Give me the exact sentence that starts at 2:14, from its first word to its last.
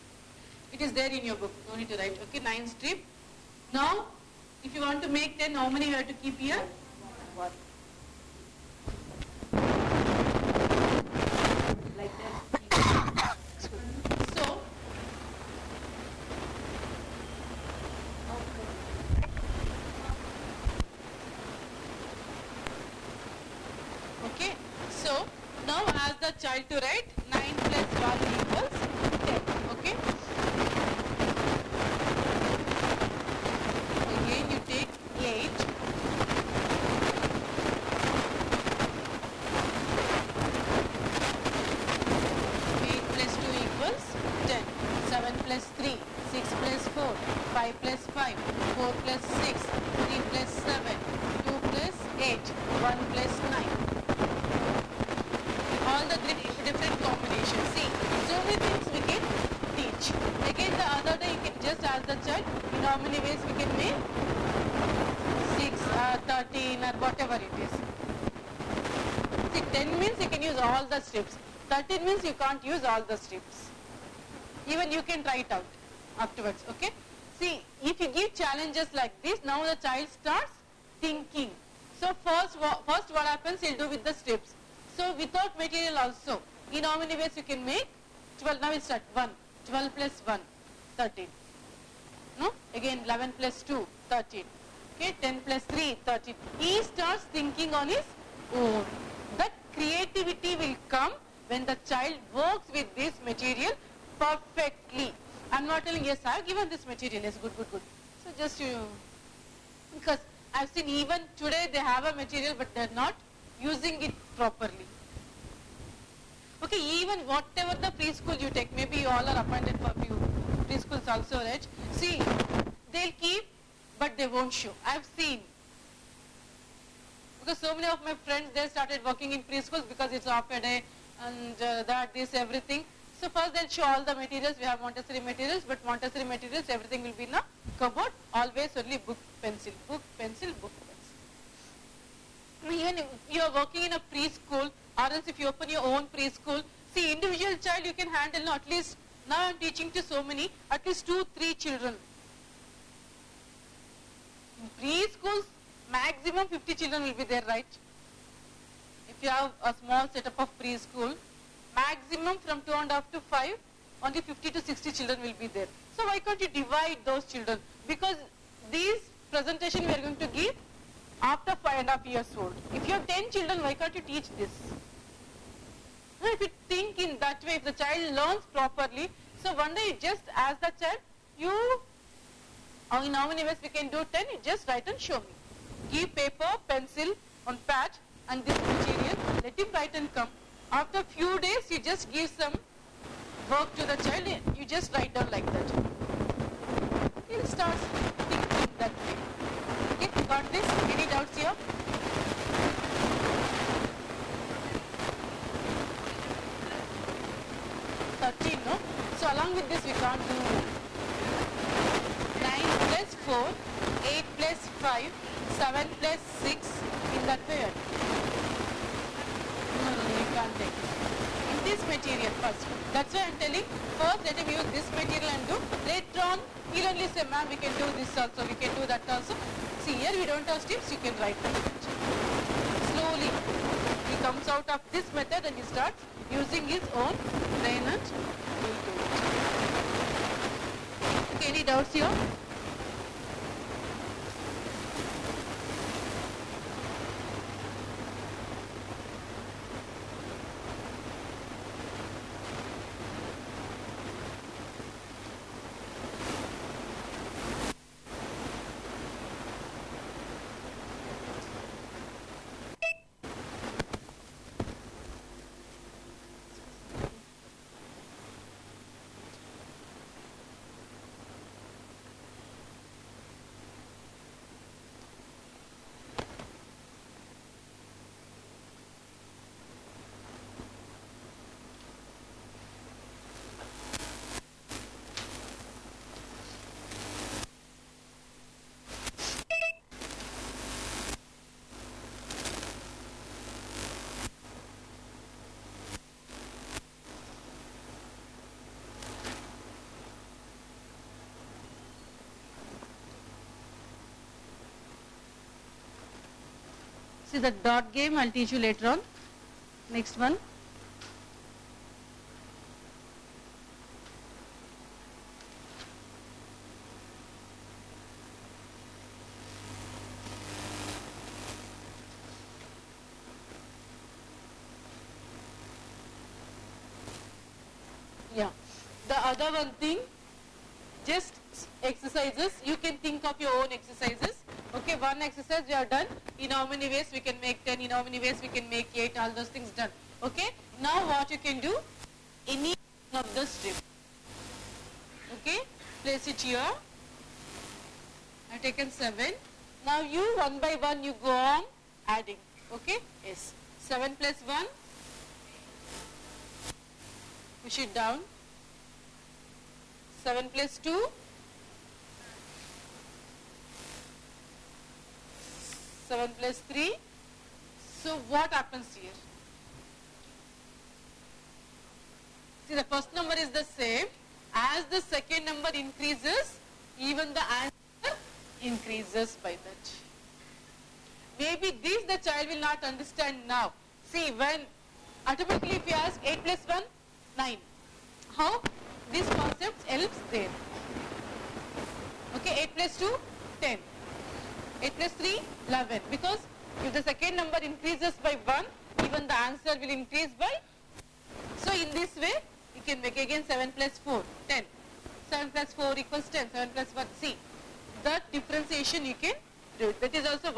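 We have Montessori materials, but Montessori materials, everything will be in a cupboard.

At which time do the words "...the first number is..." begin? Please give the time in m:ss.
6:12.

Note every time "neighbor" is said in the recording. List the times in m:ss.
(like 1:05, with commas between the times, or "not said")
not said.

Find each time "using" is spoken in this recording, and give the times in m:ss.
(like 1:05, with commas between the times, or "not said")
1:53, 3:56.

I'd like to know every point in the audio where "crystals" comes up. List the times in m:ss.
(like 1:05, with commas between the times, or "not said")
not said.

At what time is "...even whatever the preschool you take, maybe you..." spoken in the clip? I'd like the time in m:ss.
1:57.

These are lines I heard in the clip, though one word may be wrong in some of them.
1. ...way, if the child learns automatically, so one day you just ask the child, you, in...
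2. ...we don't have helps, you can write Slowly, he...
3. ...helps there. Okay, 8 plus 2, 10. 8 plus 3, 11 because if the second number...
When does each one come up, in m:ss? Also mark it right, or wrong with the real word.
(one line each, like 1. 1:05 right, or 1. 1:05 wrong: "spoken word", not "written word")
1. 2:57 wrong: "properly", not "automatically"
2. 3:50 wrong: "steps", not "helps"
3. 6:29 right.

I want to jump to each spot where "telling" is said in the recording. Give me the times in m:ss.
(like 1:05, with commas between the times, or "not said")
1:45, 3:43.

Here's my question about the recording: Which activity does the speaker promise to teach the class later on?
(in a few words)
The dot game.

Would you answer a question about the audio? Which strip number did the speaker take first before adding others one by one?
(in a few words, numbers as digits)
7.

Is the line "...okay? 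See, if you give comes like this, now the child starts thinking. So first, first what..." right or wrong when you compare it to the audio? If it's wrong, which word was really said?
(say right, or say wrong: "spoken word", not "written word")
wrong: "challenges", not "comes".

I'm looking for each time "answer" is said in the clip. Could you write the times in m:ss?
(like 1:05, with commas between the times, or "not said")
6:17, 6:39.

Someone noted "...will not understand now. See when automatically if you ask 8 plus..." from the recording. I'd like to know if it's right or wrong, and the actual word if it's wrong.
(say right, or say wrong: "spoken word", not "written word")
right.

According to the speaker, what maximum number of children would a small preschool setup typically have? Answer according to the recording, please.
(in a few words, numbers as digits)
50 to 60.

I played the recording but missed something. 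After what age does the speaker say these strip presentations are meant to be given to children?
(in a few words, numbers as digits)
5 and half years.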